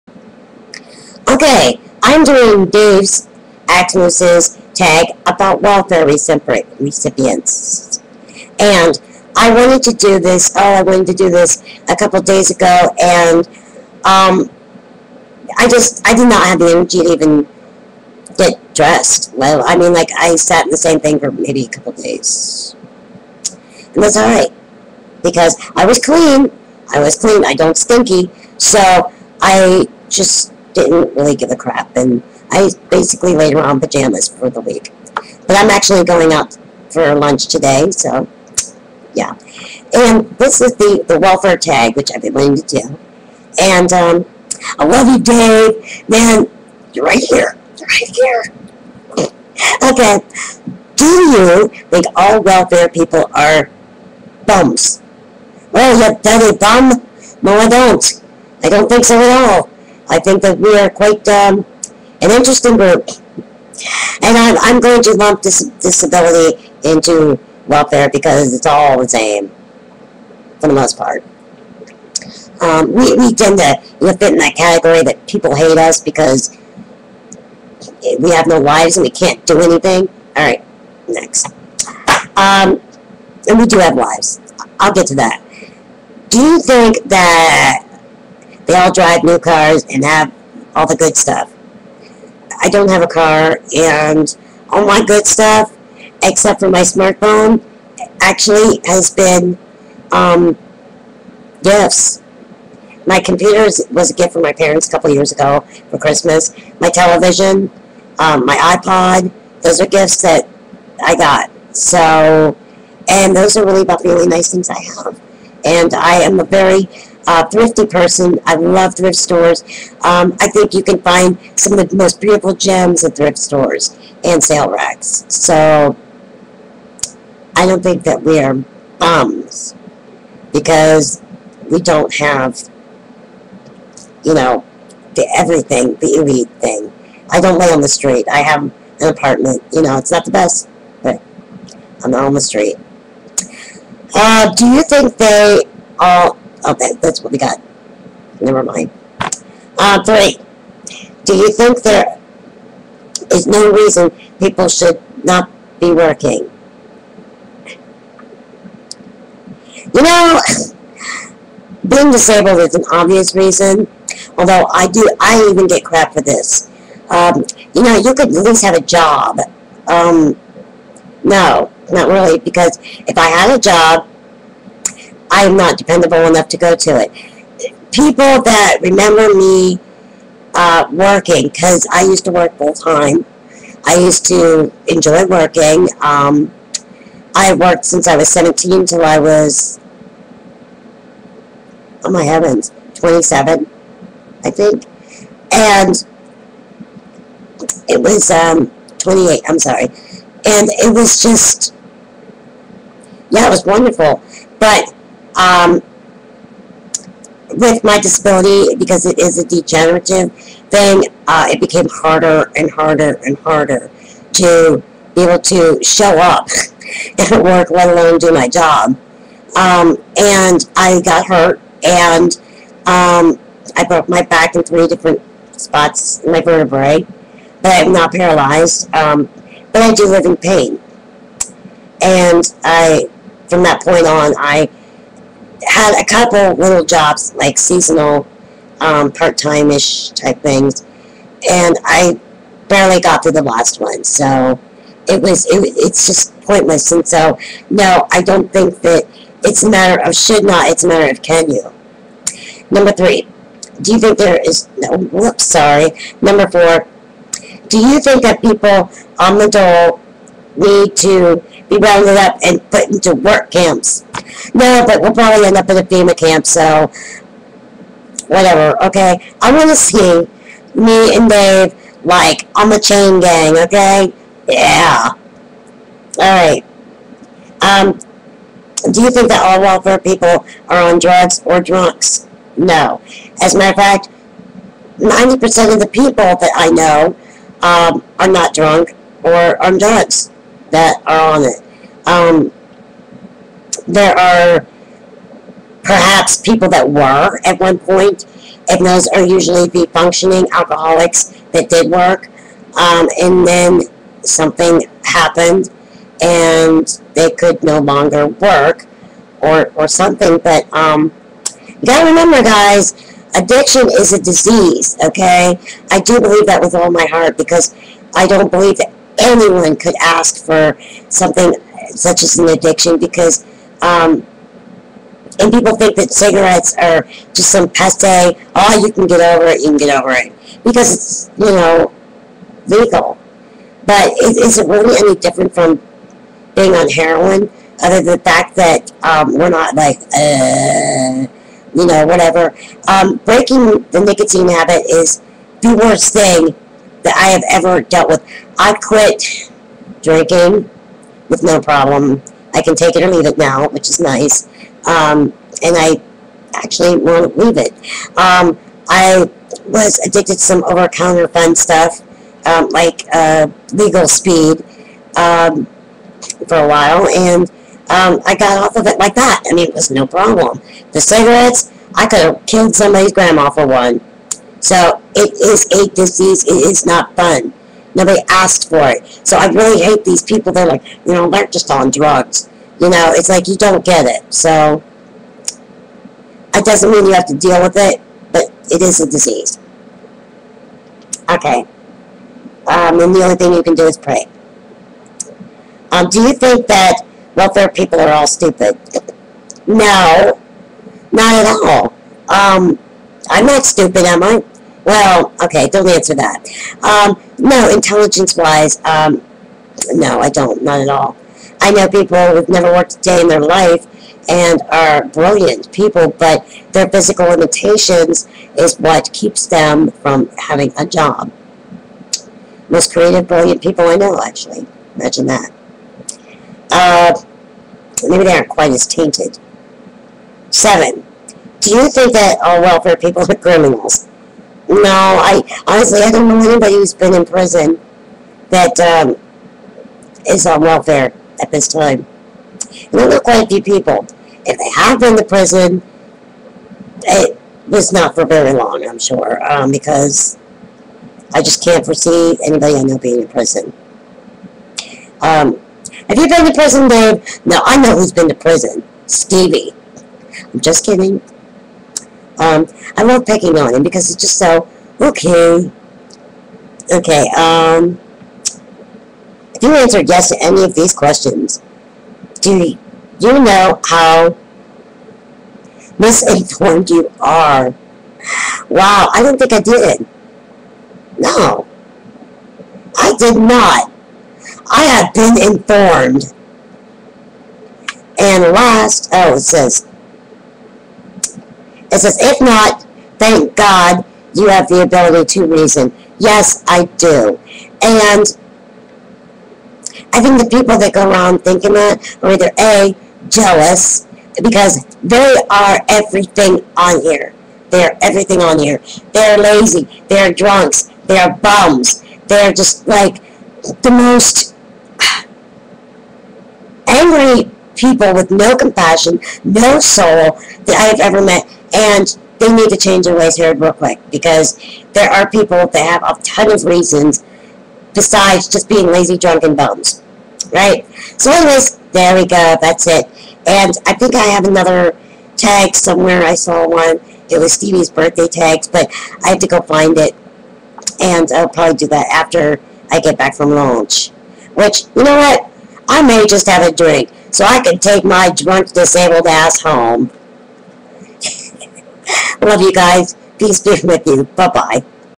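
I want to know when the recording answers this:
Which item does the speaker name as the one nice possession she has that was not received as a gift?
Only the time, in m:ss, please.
1:36.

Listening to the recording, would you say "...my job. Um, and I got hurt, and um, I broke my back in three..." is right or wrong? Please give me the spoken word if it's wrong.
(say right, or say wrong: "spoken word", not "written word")
right.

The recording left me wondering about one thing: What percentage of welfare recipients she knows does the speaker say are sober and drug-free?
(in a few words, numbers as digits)
90%.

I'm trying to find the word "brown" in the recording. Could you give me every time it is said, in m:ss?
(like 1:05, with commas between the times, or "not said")
not said.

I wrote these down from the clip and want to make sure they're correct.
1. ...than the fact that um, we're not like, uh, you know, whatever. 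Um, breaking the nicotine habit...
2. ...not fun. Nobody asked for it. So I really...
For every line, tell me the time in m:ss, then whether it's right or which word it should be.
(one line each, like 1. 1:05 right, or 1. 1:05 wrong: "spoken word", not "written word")
1. 5:38 right
2. 6:16 right.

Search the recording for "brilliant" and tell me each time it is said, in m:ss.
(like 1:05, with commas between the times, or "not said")
6:55, 7:03.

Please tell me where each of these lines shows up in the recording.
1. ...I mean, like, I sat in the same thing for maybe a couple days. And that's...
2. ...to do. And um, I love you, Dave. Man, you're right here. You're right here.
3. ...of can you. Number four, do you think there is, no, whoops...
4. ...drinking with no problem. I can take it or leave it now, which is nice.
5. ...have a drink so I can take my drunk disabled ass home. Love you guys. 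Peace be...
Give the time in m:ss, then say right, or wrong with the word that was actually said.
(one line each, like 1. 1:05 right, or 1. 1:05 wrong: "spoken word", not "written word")
1. 0:19 right
2. 0:42 right
3. 4:11 wrong: "three", not "four"
4. 5:50 right
5. 9:06 right.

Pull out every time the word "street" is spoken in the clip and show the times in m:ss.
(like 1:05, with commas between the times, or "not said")
2:17, 2:22.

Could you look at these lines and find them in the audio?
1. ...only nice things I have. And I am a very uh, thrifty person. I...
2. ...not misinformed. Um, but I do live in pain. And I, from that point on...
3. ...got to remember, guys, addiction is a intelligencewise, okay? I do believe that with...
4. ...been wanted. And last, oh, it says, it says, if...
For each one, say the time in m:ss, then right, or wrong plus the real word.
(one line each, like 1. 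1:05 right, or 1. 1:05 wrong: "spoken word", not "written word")
1. 1:54 right
2. 3:47 wrong: "paralyzed", not "misinformed"
3. 5:11 wrong: "disease", not "intelligencewise"
4. 8:05 wrong: "informed", not "wanted".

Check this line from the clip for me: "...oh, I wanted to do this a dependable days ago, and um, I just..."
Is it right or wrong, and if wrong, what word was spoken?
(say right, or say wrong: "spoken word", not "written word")
wrong: "couple", not "dependable".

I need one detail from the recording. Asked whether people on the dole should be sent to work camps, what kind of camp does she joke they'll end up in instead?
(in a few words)
FEMA camp.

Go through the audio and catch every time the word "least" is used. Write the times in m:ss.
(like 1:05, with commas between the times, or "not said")
2:48.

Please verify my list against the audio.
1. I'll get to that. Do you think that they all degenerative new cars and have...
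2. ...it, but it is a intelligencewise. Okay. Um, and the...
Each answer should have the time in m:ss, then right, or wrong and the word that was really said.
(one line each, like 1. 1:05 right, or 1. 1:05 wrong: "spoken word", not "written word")
1. 1:24 wrong: "drive", not "degenerative"
2. 6:27 wrong: "disease", not "intelligencewise".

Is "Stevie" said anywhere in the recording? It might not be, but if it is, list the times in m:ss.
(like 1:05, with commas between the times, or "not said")
7:39, 8:57.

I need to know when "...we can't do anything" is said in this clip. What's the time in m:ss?
1:19.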